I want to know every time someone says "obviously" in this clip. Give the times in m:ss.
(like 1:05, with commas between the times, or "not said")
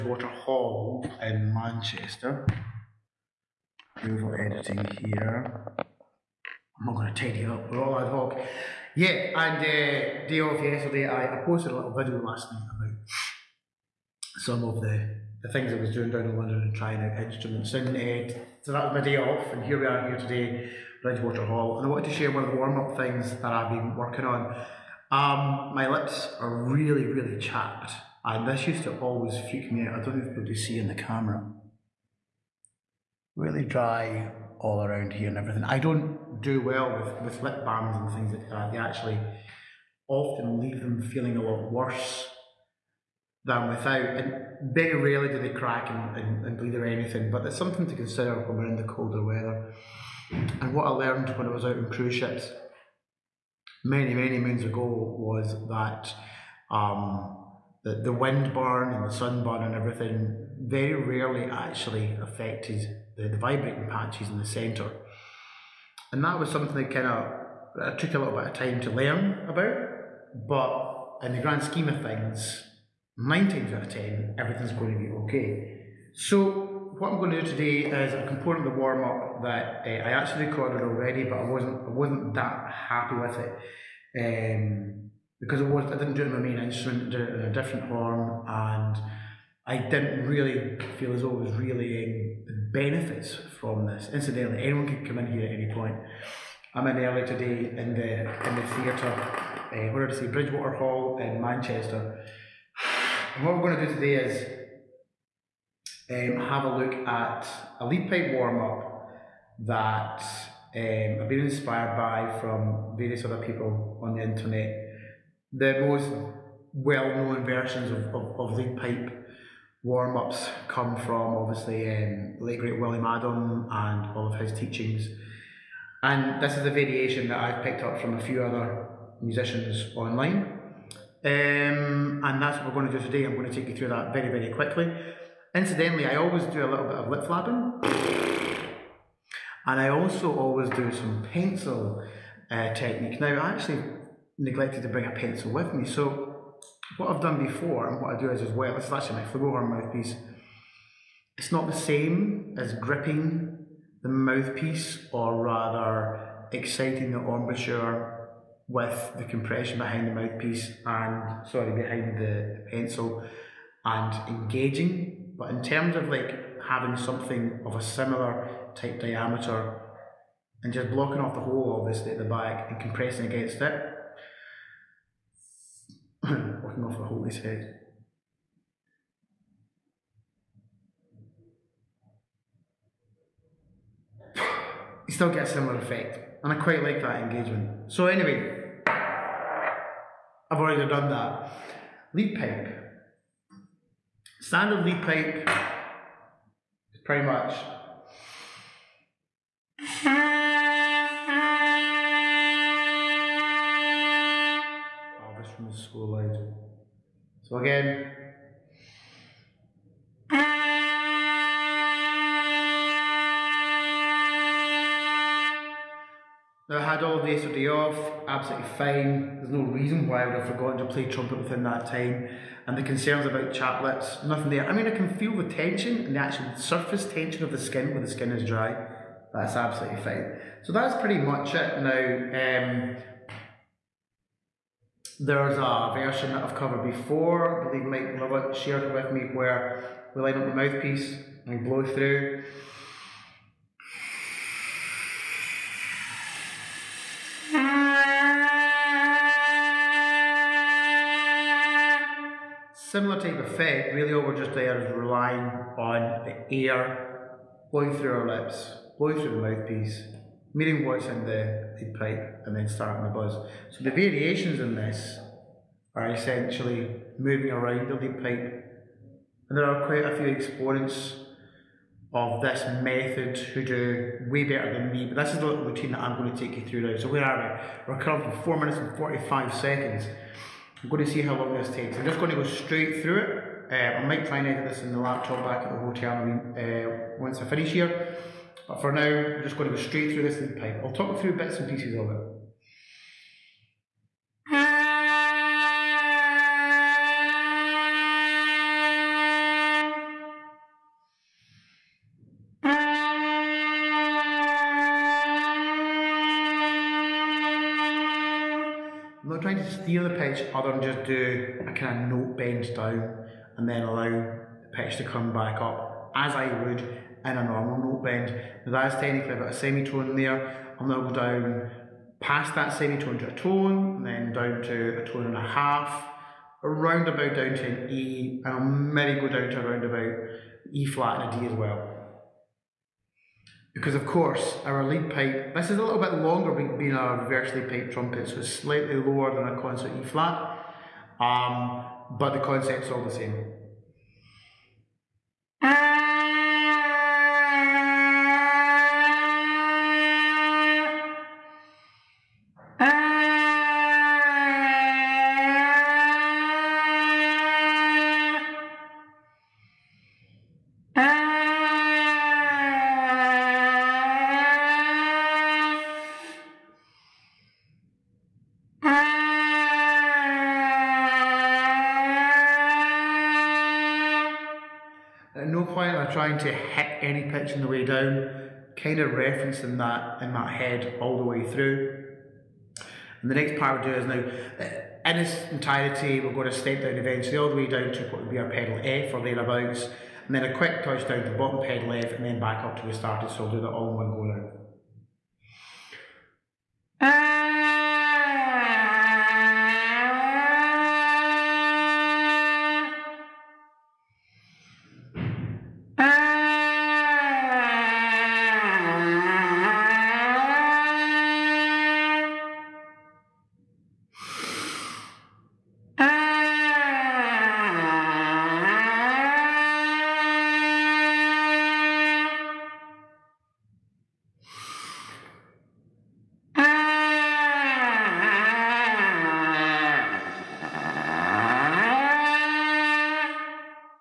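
2:01, 2:51.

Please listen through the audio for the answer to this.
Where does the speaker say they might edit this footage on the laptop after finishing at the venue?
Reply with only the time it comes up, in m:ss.
4:45.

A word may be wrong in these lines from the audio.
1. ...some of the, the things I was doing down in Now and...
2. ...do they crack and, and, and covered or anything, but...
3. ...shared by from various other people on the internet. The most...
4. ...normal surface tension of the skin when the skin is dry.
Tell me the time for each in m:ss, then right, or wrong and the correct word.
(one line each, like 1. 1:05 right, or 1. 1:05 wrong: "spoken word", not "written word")
1. 0:14 wrong: "London", not "Now"
2. 0:45 wrong: "bleed", not "covered"
3. 1:51 wrong: "inspired", not "shared"
4. 3:46 wrong: "actual", not "normal".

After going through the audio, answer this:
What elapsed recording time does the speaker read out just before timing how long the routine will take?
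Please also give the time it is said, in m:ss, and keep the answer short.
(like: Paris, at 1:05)
4 minutes 45 seconds, at 4:38.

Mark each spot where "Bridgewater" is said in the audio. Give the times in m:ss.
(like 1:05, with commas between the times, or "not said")
0:21, 1:40.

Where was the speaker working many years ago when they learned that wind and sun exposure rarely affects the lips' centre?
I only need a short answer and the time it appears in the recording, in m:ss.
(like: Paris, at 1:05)
cruise ships, at 0:51.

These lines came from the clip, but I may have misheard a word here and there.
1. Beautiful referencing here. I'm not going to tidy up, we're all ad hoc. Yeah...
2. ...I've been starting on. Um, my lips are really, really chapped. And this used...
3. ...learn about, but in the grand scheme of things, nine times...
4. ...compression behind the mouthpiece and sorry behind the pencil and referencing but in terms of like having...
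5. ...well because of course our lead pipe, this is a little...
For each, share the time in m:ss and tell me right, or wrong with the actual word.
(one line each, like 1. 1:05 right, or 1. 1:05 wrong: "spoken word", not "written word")
1. 0:04 wrong: "editing", not "referencing"
2. 0:23 wrong: "working", not "starting"
3. 1:08 right
4. 2:39 wrong: "engaging", not "referencing"
5. 5:31 right.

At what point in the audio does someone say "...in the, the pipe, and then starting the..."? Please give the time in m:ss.
4:21.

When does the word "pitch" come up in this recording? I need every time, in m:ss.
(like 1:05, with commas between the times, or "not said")
5:10, 5:14, 6:17.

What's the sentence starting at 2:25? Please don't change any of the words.
So what I've done before and what I do is as well, this is actually my flugelhorn mouthpiece.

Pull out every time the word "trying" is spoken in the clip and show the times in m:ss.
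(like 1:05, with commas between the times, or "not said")
0:16, 6:16.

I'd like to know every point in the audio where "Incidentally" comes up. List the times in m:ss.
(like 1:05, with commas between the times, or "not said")
1:34, 2:15.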